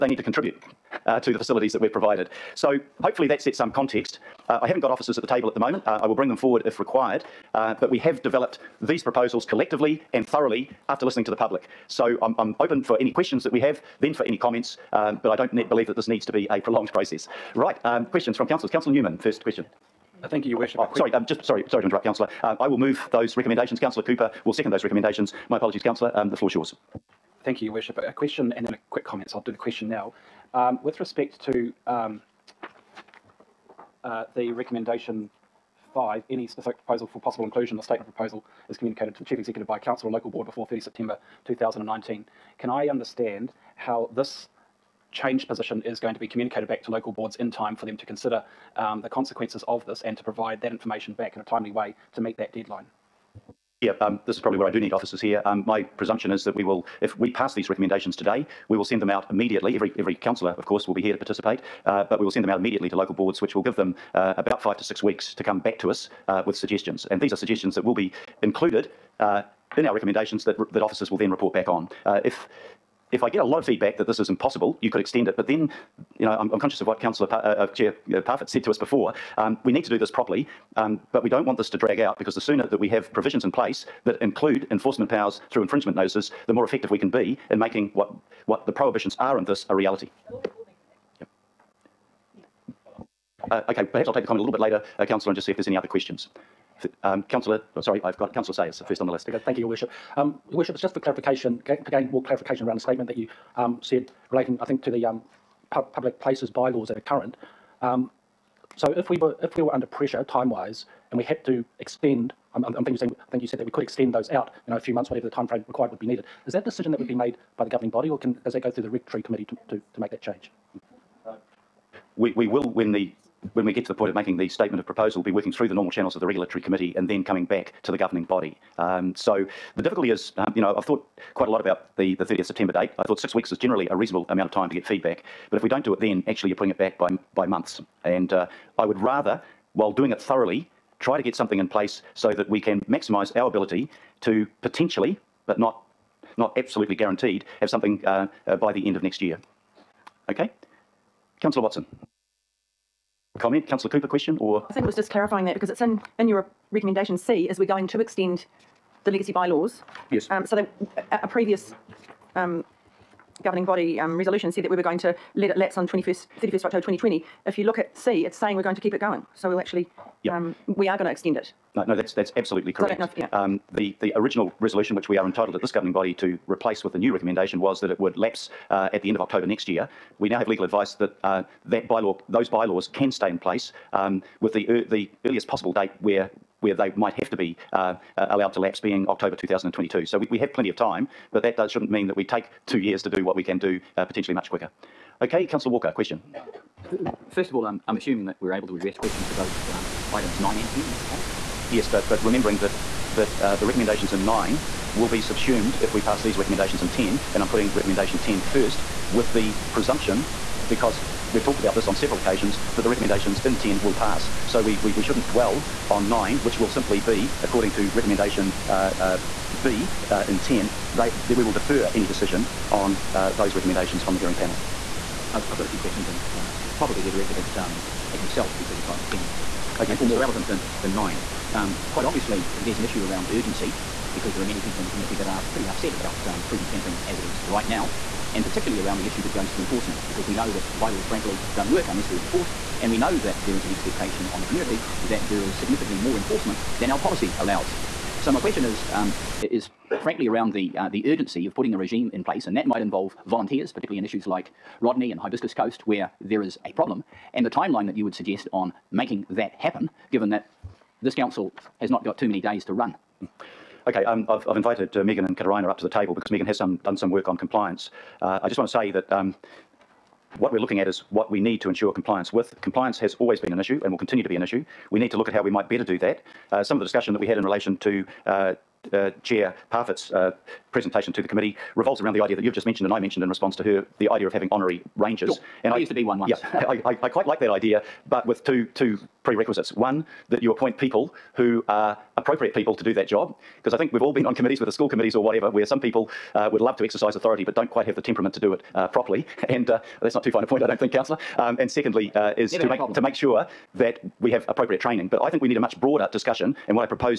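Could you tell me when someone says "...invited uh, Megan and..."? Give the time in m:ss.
4:24.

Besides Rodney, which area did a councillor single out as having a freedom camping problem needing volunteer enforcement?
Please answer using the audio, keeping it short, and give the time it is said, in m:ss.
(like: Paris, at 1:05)
Hibiscus Coast, at 4:15.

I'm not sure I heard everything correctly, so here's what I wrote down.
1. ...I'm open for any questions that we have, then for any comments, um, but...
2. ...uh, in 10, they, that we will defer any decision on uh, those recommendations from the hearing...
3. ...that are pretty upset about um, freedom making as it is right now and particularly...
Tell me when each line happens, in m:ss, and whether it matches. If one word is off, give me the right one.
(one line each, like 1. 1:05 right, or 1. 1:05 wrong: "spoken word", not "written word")
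1. 0:12 right
2. 3:40 right
3. 3:55 wrong: "camping", not "making".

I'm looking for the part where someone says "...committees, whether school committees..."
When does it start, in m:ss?
4:54.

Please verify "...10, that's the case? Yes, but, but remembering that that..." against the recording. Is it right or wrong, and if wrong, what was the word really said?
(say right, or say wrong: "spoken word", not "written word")
right.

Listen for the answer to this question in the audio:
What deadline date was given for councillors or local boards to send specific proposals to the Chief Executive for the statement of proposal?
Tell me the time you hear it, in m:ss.
0:40.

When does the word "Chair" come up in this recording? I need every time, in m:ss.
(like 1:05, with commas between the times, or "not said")
1:17, 4:39.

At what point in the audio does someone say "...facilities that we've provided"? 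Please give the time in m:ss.
0:01.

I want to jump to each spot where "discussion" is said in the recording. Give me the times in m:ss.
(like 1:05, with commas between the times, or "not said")
4:36, 5:06.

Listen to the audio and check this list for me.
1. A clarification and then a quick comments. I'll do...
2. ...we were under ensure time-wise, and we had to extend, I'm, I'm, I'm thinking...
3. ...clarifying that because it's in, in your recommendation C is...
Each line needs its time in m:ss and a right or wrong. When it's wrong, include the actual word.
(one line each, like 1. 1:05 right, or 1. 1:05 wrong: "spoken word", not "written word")
1. 0:27 wrong: "question", not "clarification"
2. 1:49 wrong: "pressure", not "ensure"
3. 2:35 right.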